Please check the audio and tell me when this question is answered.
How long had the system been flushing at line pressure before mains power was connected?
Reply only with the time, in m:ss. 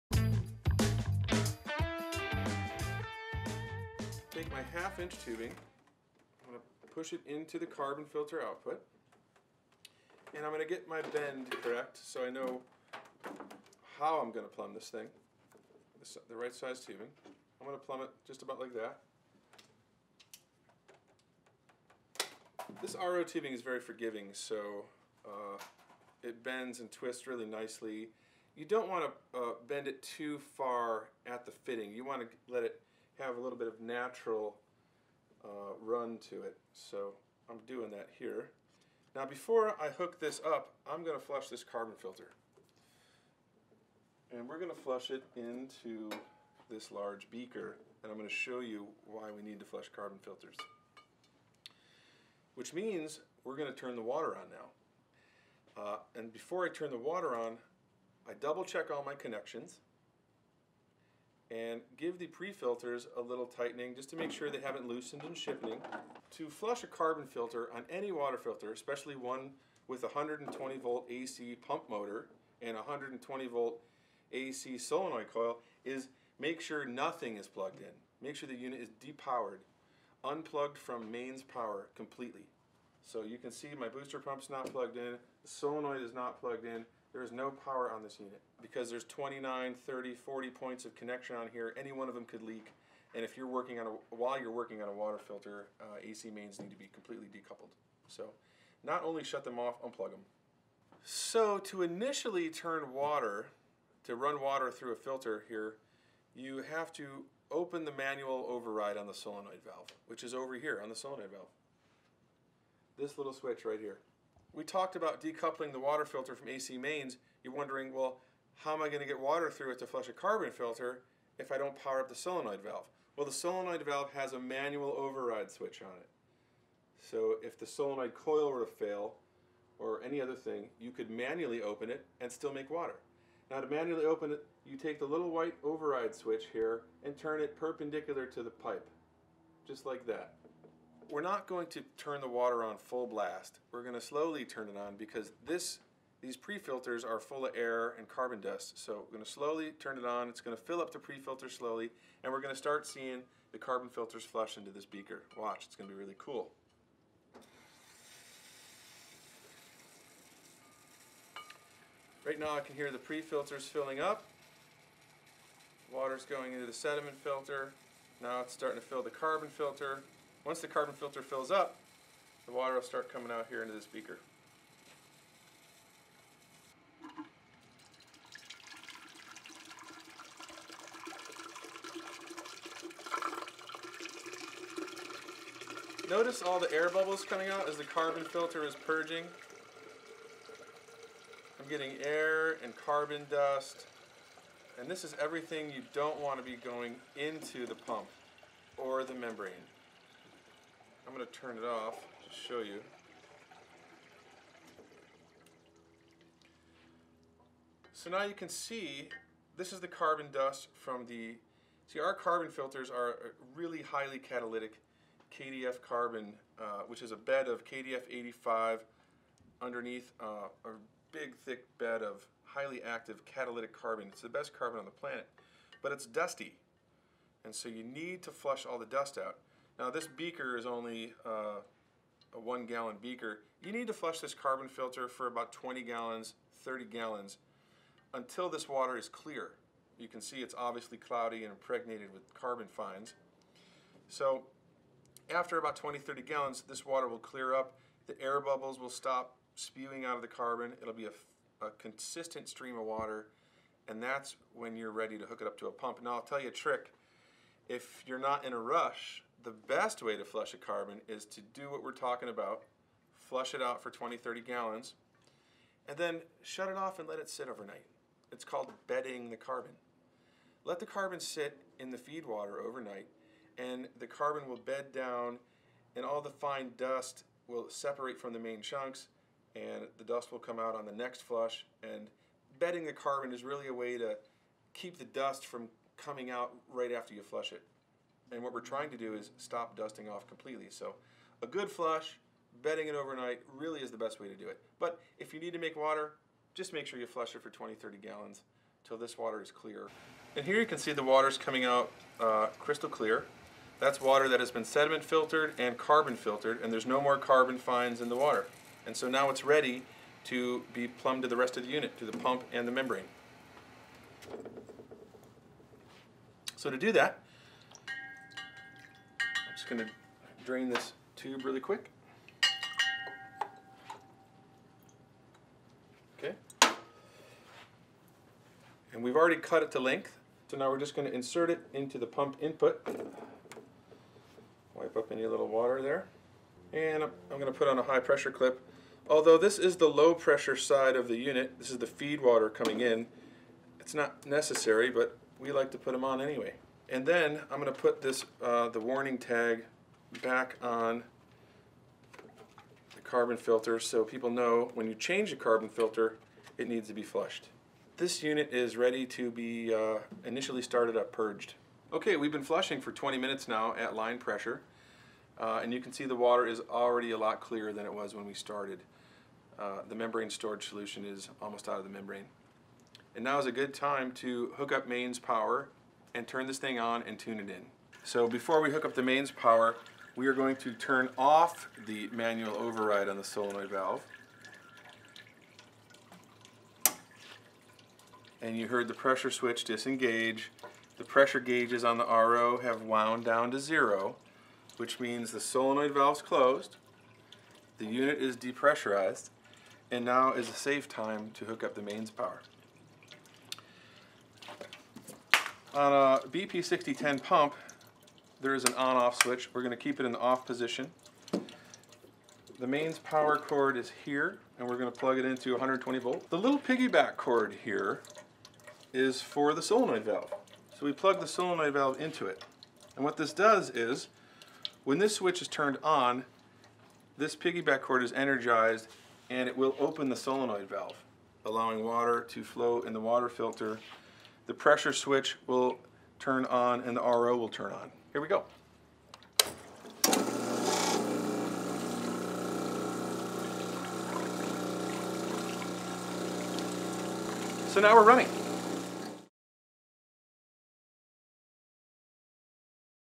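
6:02.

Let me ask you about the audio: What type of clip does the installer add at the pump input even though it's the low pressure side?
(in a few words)
high pressure clip.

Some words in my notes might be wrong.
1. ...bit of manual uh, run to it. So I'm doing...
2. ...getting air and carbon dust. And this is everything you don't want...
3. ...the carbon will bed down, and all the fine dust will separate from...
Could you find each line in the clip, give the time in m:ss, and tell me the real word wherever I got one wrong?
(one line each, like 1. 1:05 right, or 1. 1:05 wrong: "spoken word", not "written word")
1. 0:33 wrong: "natural", not "manual"
2. 3:11 right
3. 4:33 right.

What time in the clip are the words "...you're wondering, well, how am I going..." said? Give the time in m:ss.
1:57.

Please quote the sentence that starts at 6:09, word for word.
Uh, the membrane storage solution is almost out of the membrane.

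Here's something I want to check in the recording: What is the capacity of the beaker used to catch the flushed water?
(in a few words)
1 gallon.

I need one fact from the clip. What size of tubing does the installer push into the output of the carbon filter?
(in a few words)
half inch.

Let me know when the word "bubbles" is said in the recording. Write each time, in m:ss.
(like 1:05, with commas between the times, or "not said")
3:06, 4:08.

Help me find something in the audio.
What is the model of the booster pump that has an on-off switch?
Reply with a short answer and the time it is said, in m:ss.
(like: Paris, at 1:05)
BP6010, at 6:46.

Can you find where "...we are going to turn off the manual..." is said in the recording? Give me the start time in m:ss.
6:20.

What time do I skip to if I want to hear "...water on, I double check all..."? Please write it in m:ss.
0:56.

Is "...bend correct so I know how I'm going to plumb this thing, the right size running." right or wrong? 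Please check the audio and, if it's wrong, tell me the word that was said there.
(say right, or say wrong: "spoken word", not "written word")
wrong: "tubing", not "running".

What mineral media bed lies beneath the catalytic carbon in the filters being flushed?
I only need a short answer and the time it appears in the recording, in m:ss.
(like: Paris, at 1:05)
KDF 85, at 3:37.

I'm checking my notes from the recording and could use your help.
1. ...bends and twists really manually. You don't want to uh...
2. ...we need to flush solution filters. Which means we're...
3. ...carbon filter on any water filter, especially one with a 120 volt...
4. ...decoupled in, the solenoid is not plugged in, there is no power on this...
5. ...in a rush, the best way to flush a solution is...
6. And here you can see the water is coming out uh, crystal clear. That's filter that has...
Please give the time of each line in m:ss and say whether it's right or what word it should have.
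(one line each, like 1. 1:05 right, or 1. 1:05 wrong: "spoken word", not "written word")
1. 0:26 wrong: "nicely", not "manually"
2. 0:49 wrong: "carbon", not "solution"
3. 1:06 right
4. 1:24 wrong: "plugged", not "decoupled"
5. 4:18 wrong: "carbon", not "solution"
6. 5:00 wrong: "water", not "filter".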